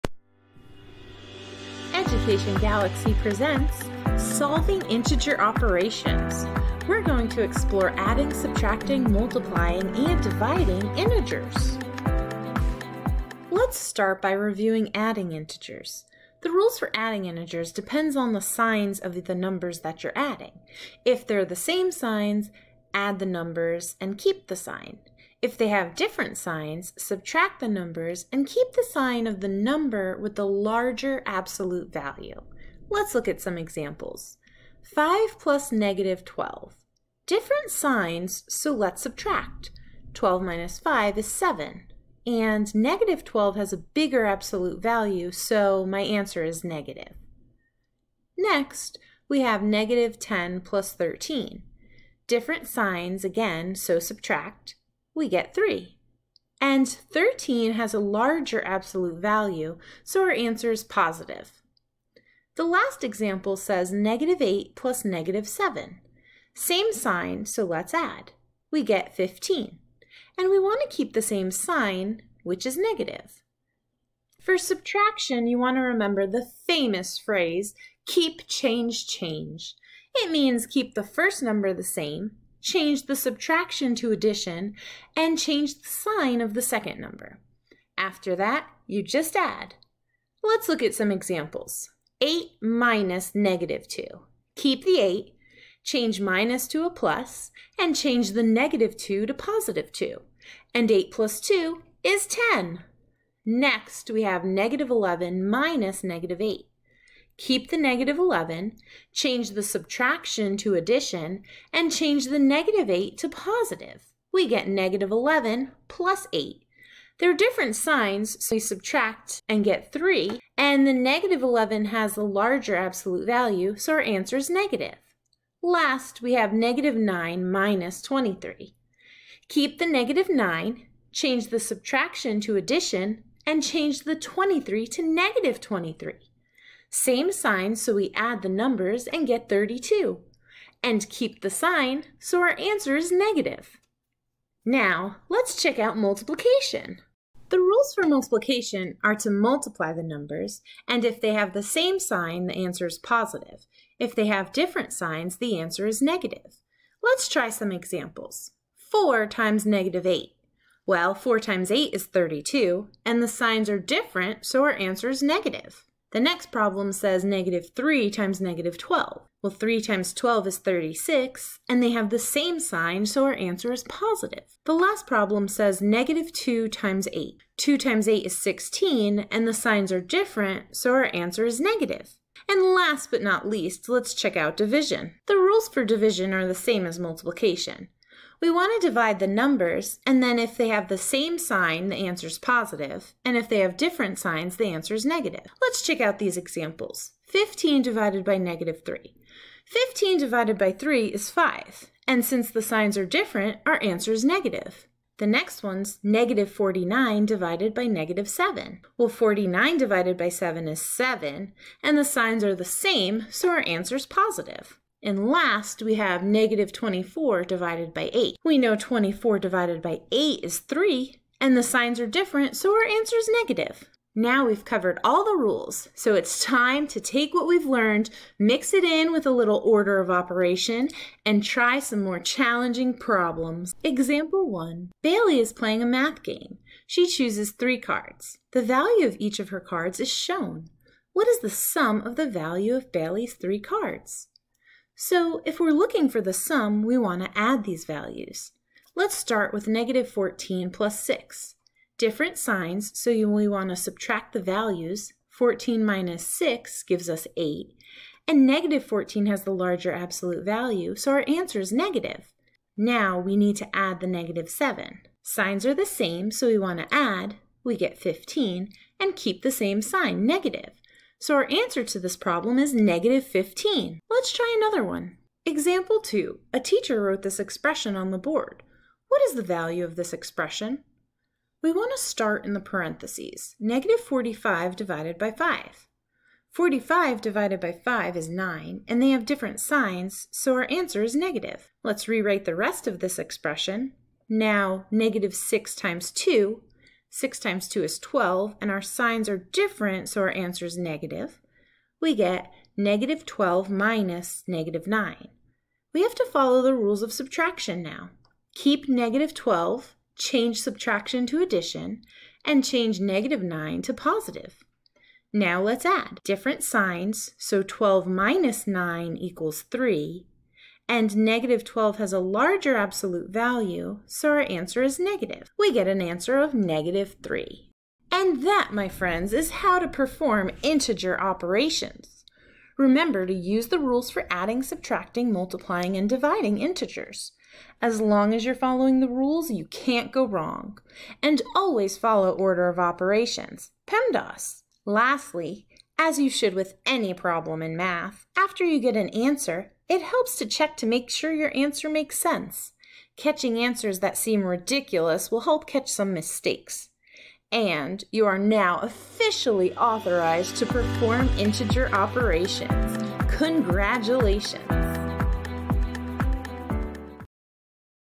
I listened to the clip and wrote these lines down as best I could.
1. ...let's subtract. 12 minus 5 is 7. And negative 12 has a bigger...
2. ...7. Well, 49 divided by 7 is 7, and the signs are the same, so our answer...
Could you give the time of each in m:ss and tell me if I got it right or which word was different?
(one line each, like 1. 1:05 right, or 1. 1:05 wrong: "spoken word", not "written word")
1. 0:38 right
2. 3:28 right.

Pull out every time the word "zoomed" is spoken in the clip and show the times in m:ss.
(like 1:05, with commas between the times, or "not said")
not said.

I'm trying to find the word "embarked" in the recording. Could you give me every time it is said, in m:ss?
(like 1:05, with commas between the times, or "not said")
not said.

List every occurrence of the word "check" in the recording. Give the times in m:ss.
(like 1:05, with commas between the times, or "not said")
2:25, 3:04, 3:15, 5:50.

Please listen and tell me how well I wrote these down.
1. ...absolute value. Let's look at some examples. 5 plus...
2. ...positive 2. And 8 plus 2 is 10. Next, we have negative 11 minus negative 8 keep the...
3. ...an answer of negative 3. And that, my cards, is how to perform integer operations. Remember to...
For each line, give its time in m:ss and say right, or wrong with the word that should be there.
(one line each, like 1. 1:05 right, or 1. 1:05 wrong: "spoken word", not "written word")
1. 0:31 right
2. 1:39 right
3. 5:25 wrong: "friends", not "cards".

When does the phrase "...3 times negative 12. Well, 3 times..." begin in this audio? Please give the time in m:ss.
2:47.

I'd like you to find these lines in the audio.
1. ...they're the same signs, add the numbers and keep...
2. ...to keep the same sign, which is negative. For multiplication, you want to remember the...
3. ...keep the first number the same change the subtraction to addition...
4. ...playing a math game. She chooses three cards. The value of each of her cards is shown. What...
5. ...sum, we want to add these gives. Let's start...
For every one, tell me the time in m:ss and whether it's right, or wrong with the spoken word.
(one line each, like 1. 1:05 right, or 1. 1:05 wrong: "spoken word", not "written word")
1. 0:21 right
2. 1:10 wrong: "subtraction", not "multiplication"
3. 1:20 right
4. 3:55 right
5. 4:06 wrong: "values", not "gives".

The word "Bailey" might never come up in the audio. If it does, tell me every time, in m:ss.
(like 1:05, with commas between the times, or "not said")
3:55, 4:02.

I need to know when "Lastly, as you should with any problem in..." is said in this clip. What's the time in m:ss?
5:44.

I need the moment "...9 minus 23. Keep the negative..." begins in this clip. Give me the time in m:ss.
2:06.